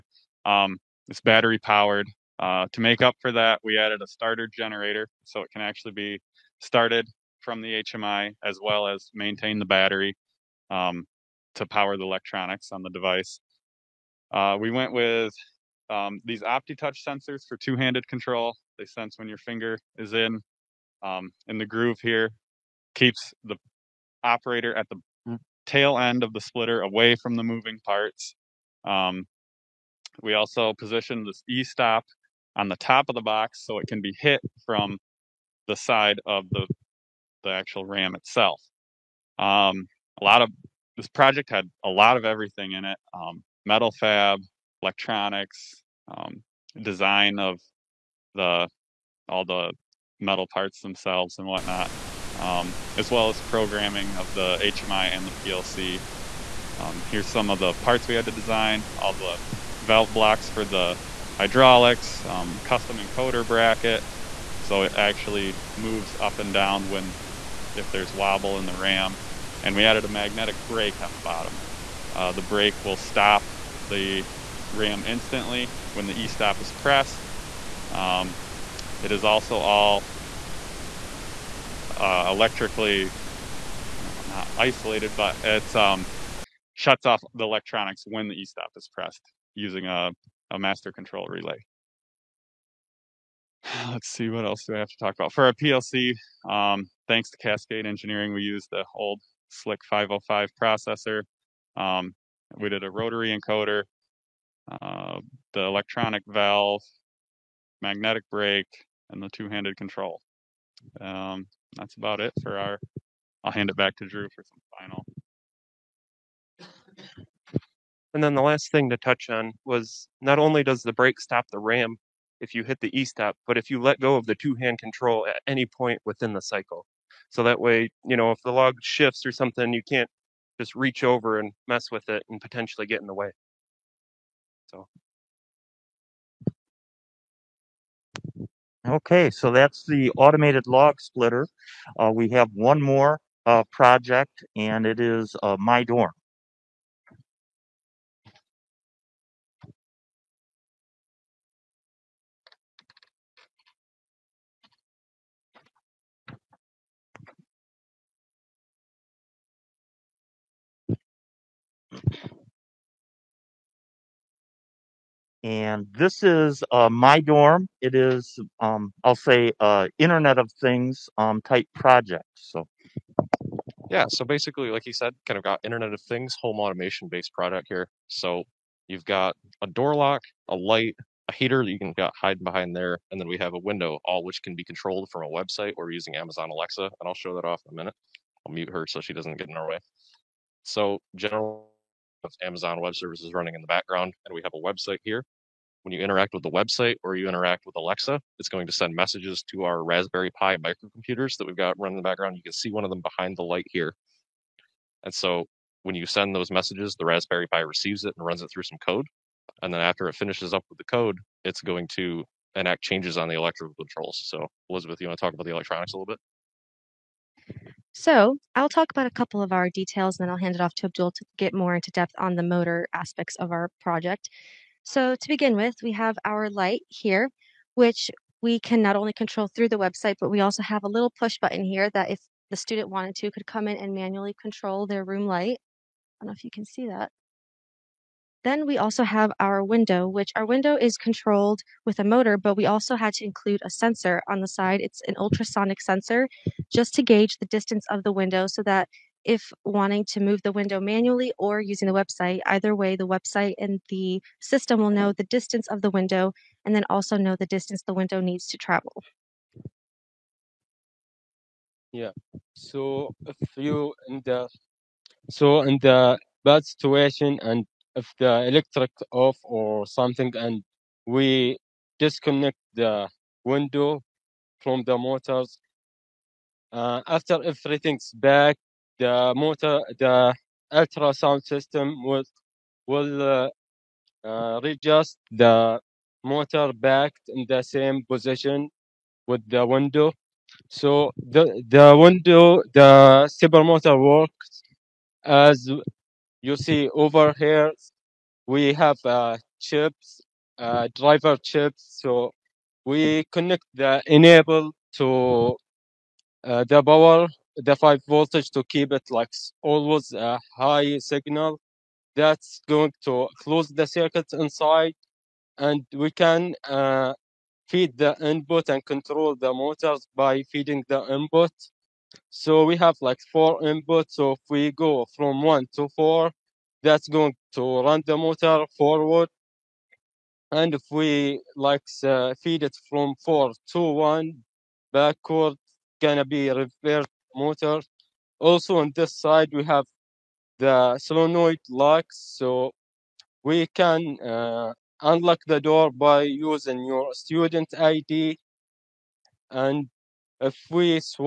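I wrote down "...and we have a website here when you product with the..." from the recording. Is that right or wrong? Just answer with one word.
wrong.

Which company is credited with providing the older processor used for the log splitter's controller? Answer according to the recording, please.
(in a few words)
Cascade Engineering.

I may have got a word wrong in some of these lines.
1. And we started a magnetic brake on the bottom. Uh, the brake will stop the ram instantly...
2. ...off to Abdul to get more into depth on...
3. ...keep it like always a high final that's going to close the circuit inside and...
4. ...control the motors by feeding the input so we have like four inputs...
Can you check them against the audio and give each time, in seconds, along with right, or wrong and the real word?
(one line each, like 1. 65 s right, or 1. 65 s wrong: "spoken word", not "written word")
1. 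69 s wrong: "added", not "started"
2. 220 s right
3. 308 s wrong: "signal", not "final"
4. 318 s right.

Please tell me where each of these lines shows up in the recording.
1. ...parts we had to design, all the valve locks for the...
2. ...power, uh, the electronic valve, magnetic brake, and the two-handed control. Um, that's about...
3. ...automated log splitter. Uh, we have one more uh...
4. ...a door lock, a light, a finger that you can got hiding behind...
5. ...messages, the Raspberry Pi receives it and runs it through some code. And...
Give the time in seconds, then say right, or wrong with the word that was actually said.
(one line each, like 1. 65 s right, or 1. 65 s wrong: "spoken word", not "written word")
1. 57 s wrong: "blocks", not "locks"
2. 103 s wrong: "encoder", not "power"
3. 140 s right
4. 179 s wrong: "heater", not "finger"
5. 206 s right.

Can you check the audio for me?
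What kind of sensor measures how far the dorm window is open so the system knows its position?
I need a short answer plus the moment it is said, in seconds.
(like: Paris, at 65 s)
ultrasonic sensor, at 245 s.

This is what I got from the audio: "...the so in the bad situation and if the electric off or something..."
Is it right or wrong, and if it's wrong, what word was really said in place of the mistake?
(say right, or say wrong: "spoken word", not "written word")
right.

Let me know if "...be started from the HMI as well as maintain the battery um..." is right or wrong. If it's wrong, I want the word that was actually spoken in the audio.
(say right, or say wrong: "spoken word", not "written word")
right.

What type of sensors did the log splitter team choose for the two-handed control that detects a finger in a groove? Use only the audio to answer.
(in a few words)
Opto-Touch sensors.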